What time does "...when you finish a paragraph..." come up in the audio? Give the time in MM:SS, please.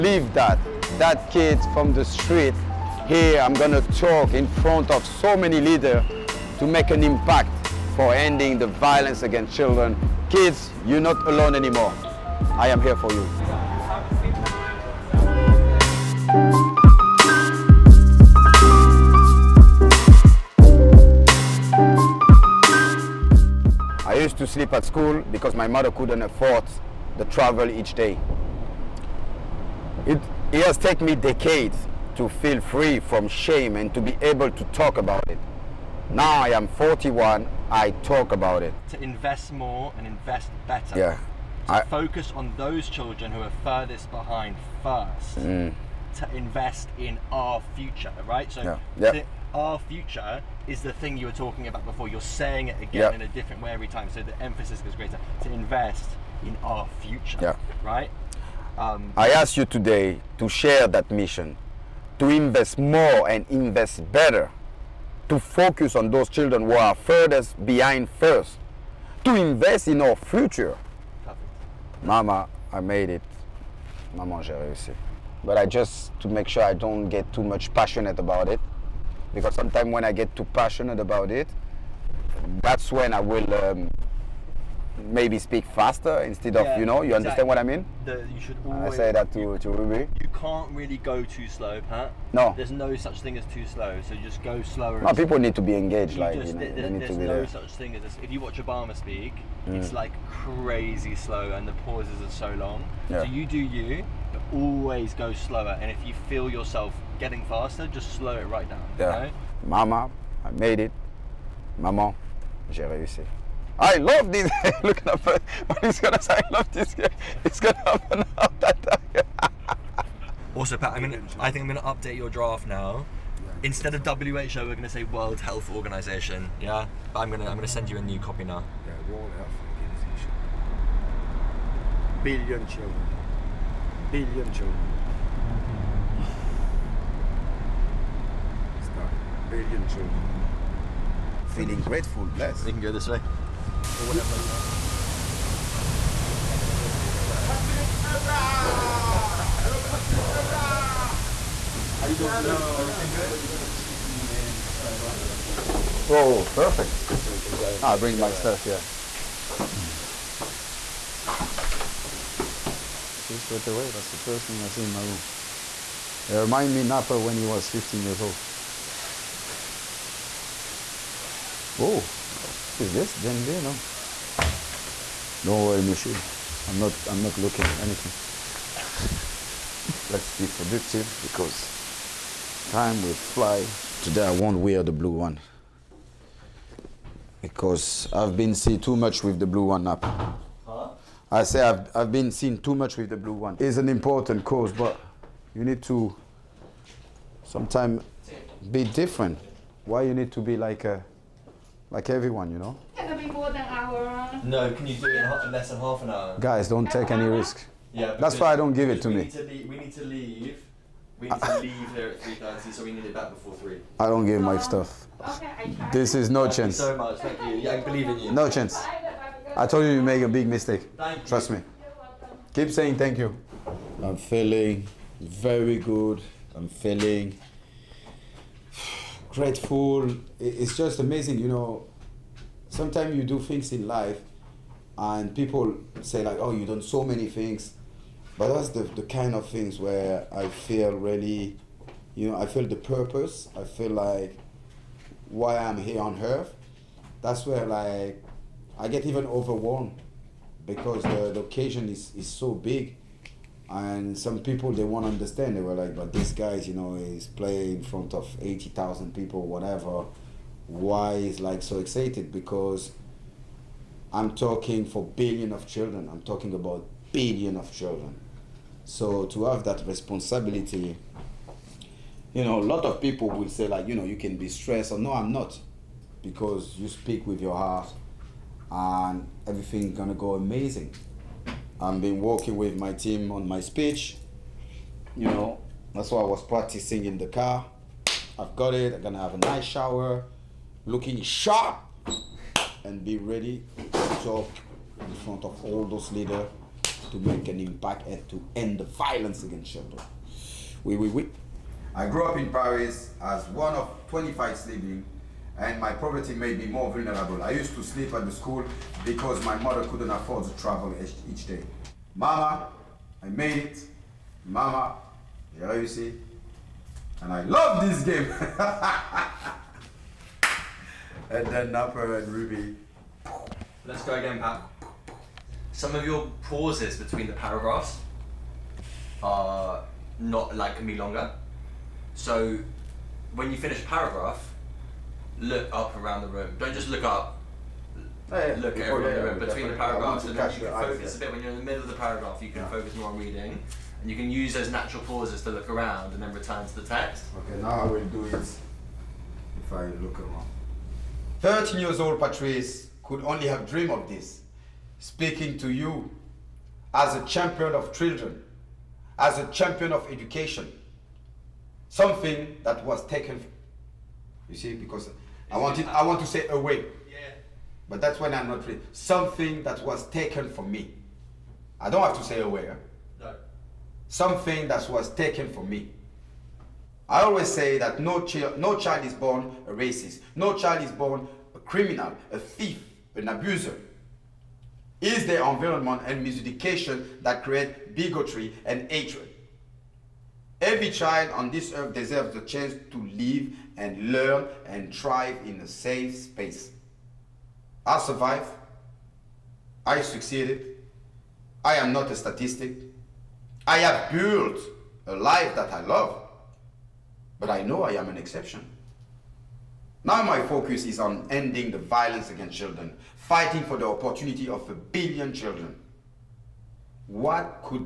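05:33.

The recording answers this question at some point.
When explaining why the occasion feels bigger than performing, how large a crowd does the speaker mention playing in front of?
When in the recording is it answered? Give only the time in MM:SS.
04:18.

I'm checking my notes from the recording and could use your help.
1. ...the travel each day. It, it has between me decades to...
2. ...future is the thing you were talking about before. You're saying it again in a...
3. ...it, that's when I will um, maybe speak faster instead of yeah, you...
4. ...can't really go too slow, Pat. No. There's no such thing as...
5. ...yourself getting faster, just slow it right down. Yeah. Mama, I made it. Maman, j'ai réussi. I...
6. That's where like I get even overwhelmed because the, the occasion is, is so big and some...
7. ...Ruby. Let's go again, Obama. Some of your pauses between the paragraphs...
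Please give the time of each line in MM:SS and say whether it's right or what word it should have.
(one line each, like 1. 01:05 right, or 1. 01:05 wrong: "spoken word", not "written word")
1. 00:27 wrong: "taken", not "between"
2. 00:49 right
3. 01:21 right
4. 01:30 right
5. 01:46 right
6. 04:07 right
7. 05:22 wrong: "Pat", not "Obama".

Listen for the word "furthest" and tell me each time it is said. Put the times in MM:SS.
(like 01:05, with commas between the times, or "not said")
00:43, 01:06.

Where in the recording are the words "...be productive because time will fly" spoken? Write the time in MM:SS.
03:00.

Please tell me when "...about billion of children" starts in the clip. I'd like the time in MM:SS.
04:26.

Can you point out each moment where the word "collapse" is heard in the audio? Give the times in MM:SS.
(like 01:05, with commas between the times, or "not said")
not said.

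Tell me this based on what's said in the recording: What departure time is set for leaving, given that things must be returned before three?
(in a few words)
3:30.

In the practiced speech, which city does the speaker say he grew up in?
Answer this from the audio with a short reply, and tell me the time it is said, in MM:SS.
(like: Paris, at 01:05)
Paris, at 05:02.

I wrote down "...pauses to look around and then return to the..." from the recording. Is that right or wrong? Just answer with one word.
right.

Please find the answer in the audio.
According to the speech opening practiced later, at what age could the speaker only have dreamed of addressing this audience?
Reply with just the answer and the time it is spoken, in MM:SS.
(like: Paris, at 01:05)
13, at 05:51.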